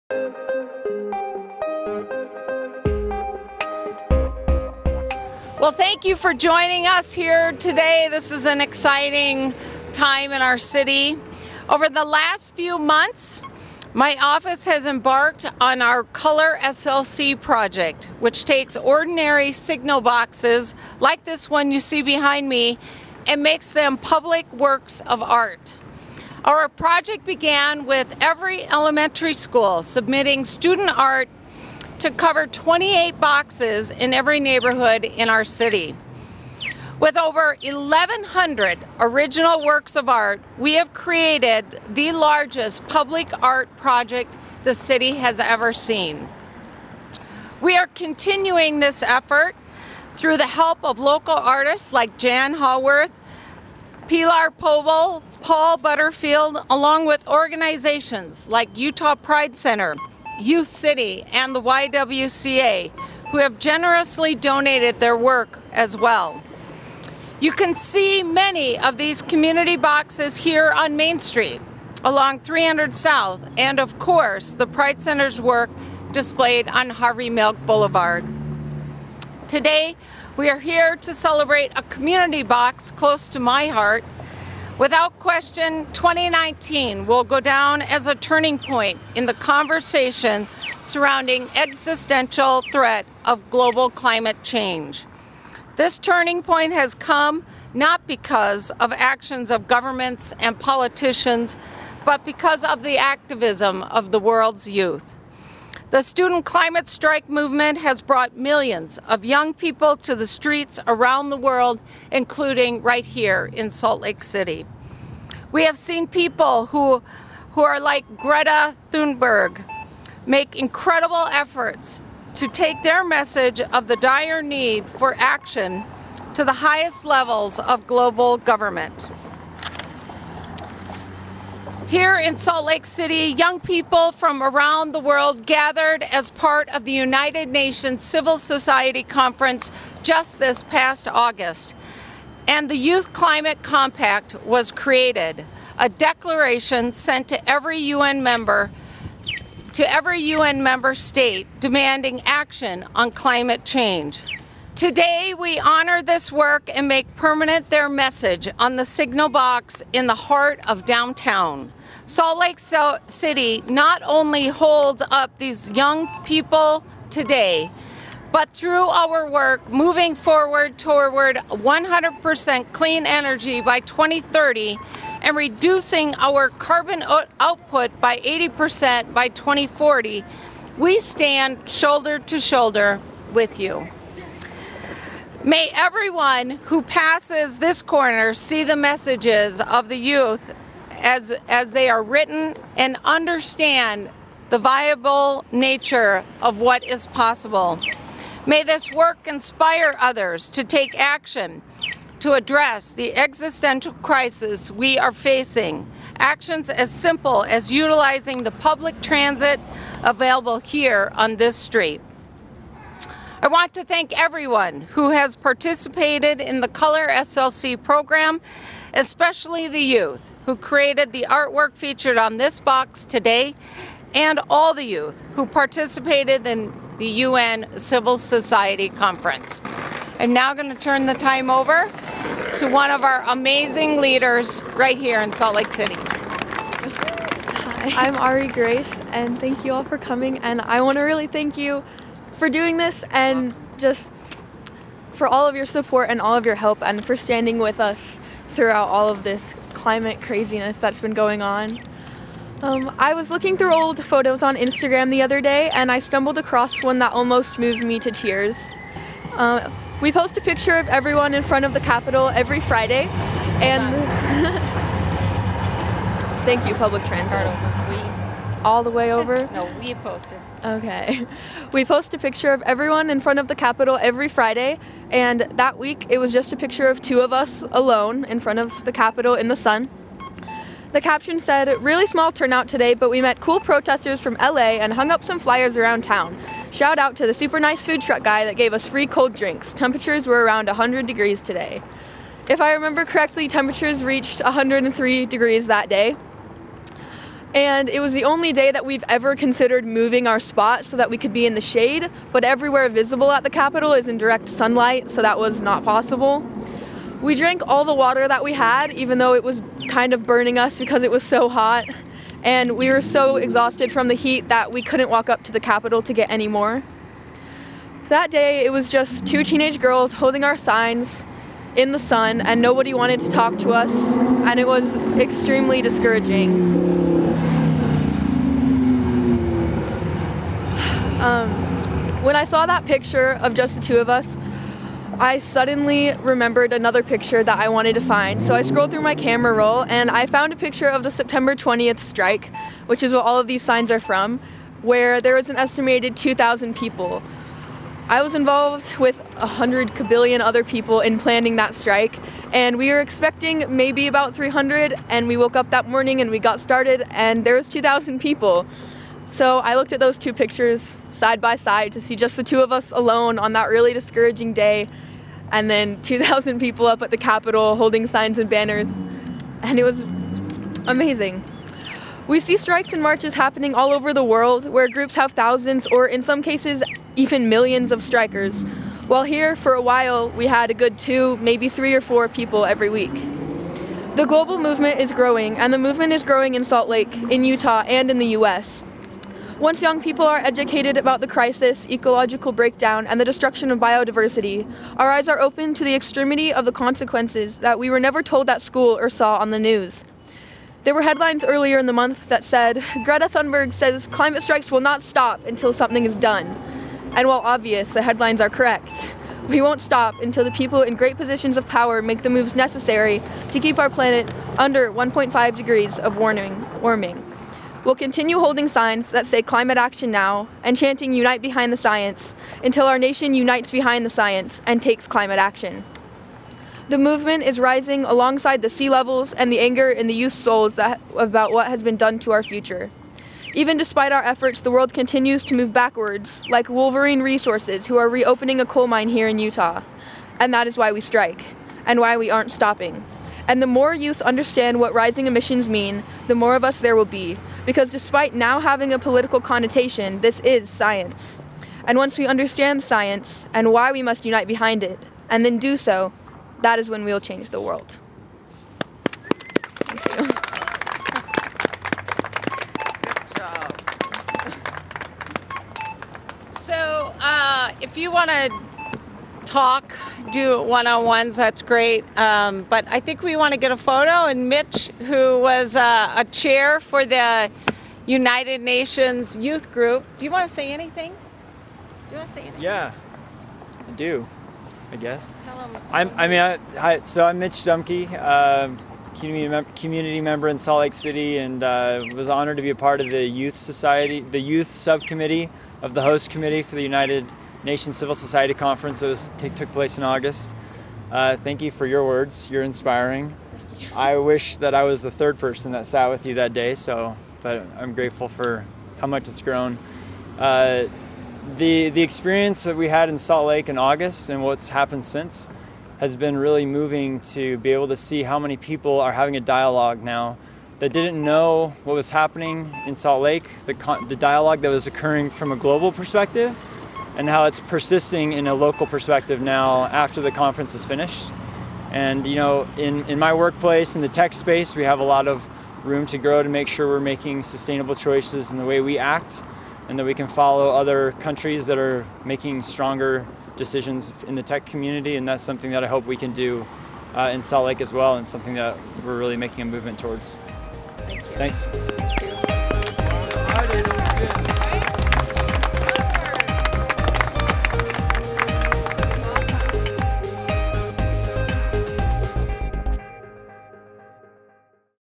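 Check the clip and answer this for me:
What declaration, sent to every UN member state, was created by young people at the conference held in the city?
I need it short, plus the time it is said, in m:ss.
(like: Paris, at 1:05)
Youth Climate Compact, at 2:22.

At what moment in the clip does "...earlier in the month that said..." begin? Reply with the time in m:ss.
6:41.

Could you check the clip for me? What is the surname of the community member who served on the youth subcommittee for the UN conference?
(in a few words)
Dumke.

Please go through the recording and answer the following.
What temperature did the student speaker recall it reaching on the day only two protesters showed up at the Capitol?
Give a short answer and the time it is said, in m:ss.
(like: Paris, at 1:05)
103 degrees, at 4:54.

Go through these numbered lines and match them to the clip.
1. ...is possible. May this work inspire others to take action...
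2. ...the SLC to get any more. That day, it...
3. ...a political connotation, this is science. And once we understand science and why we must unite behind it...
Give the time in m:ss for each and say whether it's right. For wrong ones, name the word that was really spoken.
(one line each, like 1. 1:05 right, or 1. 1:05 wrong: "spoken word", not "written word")
1. 3:16 right
2. 5:15 wrong: "Capitol", not "SLC"
3. 7:28 right.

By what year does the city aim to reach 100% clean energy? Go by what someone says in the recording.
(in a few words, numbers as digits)
2030.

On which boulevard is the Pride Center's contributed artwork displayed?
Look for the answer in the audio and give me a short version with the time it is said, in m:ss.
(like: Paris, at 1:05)
Harvey Milk Boulevard, at 1:16.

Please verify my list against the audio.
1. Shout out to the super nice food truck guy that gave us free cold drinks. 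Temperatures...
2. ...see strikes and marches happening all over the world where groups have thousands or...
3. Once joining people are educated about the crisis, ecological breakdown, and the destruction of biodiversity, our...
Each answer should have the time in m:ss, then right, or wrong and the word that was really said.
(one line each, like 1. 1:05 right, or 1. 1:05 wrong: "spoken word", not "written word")
1. 4:46 right
2. 6:12 right
3. 6:29 wrong: "young", not "joining".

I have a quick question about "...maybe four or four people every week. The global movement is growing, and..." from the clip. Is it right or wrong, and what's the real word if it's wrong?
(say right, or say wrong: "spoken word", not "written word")
wrong: "three", not "four".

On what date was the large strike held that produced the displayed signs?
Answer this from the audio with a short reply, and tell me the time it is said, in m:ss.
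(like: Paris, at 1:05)
September 20th, at 5:41.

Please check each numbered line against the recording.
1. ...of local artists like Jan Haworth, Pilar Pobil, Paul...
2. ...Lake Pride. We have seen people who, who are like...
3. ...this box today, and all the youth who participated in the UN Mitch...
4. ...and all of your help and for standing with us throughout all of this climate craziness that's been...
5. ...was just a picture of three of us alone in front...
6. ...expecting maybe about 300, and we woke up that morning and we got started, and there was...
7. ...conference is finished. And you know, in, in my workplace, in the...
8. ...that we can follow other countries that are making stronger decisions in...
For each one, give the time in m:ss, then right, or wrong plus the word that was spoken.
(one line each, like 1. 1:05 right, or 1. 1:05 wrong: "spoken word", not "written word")
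1. 0:50 right
2. 1:54 wrong: "City", not "Pride"
3. 3:42 wrong: "Civil", not "Mitch"
4. 4:06 right
5. 4:36 wrong: "two", not "three"
6. 5:52 right
7. 8:50 right
8. 8:59 right.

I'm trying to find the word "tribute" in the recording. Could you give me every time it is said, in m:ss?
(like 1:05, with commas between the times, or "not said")
not said.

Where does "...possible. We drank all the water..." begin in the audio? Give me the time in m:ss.
5:05.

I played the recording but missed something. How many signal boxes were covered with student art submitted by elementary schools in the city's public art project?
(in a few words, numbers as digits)
28.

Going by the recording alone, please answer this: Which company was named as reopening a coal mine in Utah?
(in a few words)
Wolverine Resources.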